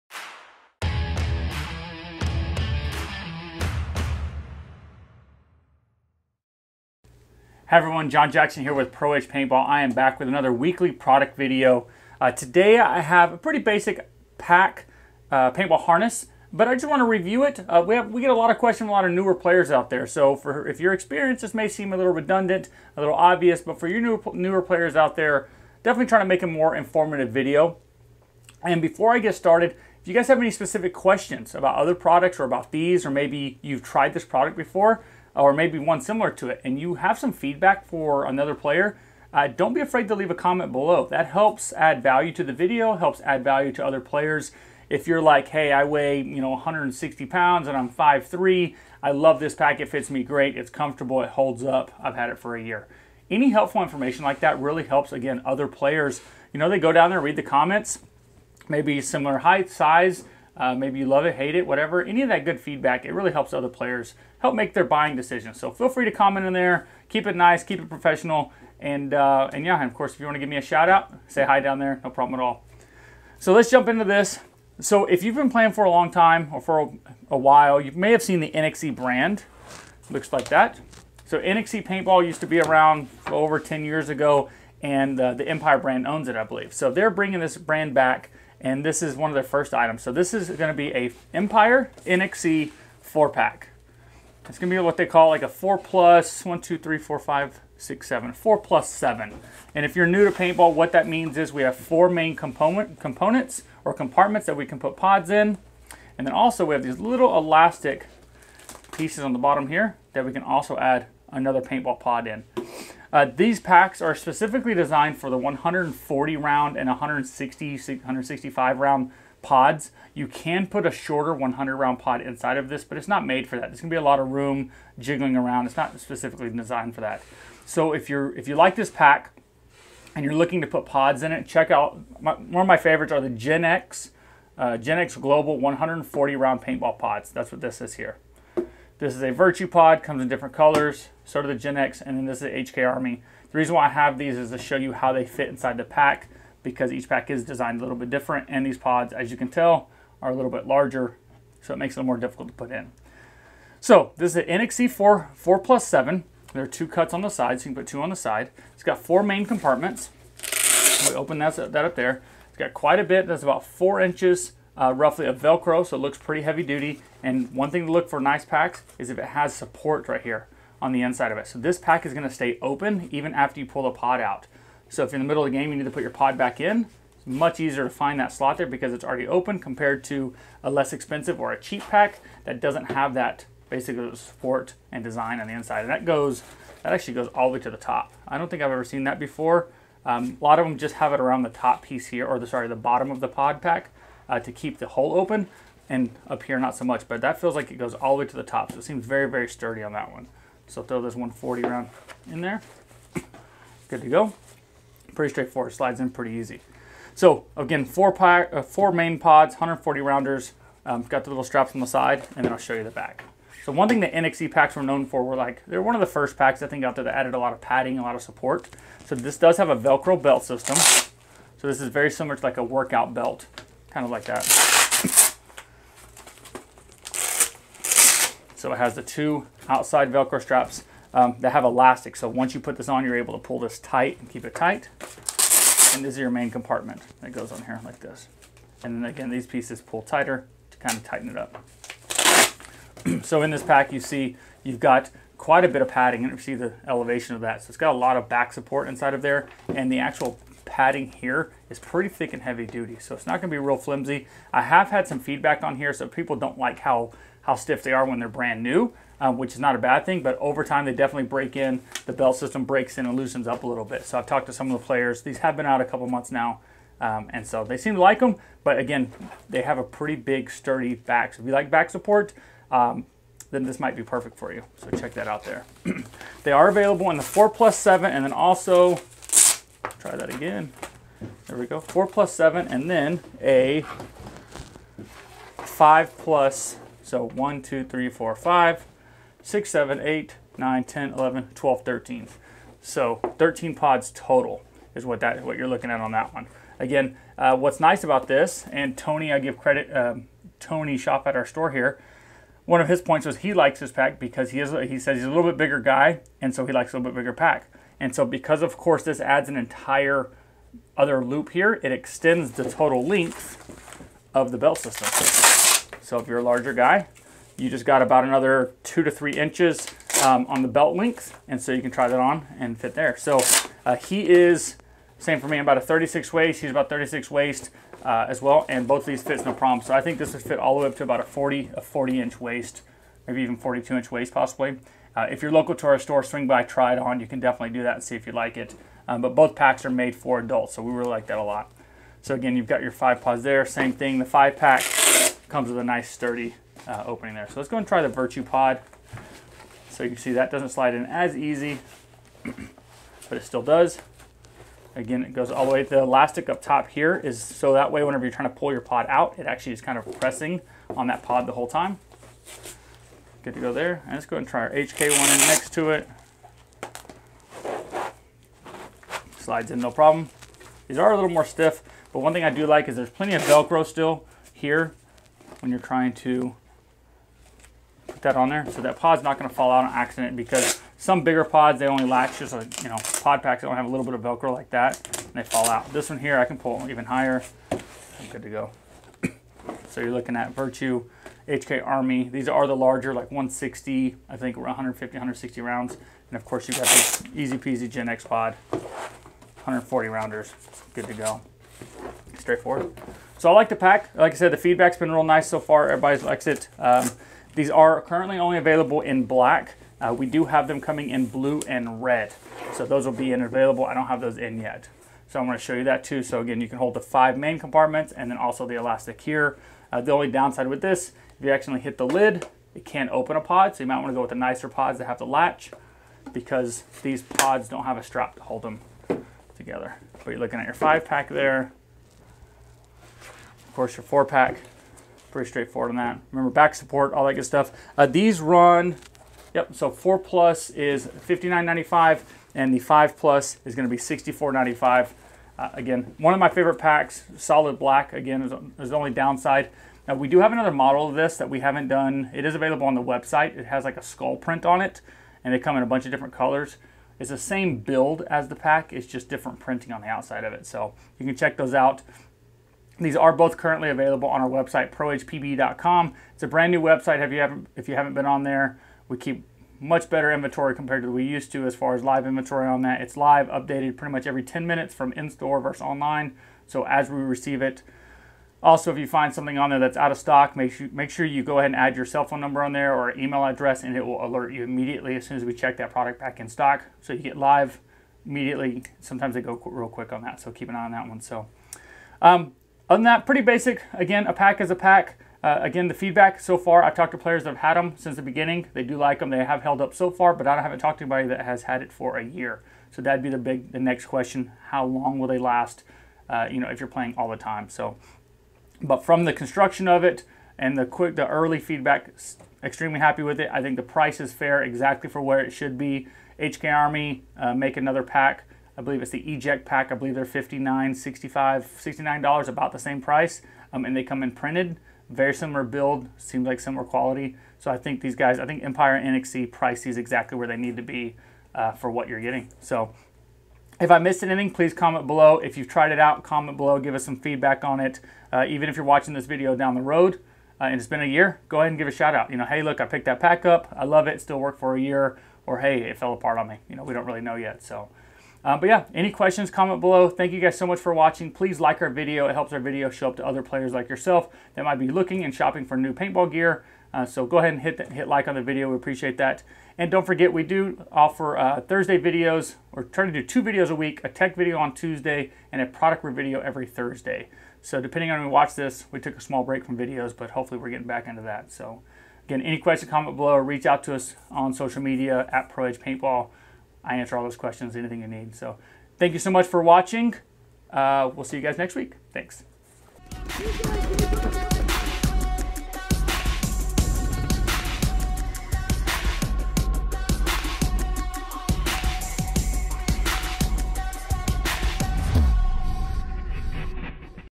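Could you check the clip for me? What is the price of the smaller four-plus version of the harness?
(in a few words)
$59.95.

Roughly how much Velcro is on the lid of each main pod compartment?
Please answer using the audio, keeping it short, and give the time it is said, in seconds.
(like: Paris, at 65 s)
4 inches, at 163 s.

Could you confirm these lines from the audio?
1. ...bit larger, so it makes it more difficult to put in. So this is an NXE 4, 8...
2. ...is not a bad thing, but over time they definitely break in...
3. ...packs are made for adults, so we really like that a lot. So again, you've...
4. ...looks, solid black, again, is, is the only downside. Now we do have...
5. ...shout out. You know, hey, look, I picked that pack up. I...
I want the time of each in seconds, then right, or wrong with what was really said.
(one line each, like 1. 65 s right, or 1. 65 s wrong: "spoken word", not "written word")
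1. 150 s wrong: "4", not "8"
2. 259 s right
3. 339 s right
4. 446 s wrong: "packs", not "looks"
5. 541 s right.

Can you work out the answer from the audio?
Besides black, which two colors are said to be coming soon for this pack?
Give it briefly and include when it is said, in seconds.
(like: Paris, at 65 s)
blue and red, at 411 s.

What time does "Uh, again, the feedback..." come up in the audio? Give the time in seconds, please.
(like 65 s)
495 s.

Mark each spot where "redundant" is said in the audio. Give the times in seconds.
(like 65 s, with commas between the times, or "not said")
22 s.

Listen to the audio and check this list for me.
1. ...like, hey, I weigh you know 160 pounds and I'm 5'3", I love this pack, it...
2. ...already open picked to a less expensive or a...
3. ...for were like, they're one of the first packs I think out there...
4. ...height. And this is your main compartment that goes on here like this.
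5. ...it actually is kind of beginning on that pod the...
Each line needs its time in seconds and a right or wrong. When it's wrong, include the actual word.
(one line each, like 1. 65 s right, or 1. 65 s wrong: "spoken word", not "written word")
1. 45 s right
2. 179 s wrong: "compared", not "picked"
3. 215 s right
4. 234 s wrong: "tight", not "height"
5. 359 s wrong: "pressing", not "beginning".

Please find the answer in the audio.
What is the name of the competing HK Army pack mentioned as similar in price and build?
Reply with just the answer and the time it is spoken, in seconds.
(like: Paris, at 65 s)
Eject pack, at 519 s.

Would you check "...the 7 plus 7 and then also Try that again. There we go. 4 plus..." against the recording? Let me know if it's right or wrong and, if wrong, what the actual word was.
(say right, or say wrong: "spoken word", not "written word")
wrong: "4", not "7".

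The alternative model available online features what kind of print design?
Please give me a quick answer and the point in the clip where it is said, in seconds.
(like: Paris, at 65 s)
skull print, at 454 s.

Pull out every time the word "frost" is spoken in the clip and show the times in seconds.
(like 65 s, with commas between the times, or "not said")
not said.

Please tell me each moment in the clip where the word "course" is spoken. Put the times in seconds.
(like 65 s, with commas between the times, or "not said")
69 s, 308 s, 396 s, 433 s.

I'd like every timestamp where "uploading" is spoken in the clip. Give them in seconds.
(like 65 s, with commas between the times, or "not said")
not said.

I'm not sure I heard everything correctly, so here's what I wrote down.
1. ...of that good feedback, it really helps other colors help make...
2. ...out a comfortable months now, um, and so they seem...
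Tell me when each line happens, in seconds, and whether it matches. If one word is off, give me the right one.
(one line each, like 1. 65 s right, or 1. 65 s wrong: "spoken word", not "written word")
1. 62 s wrong: "players", not "colors"
2. 265 s wrong: "couple", not "comfortable".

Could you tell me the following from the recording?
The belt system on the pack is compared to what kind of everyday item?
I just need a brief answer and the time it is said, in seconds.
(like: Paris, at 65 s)
workout belt, at 222 s.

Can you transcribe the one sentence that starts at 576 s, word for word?
I answer all those questions, anything you need.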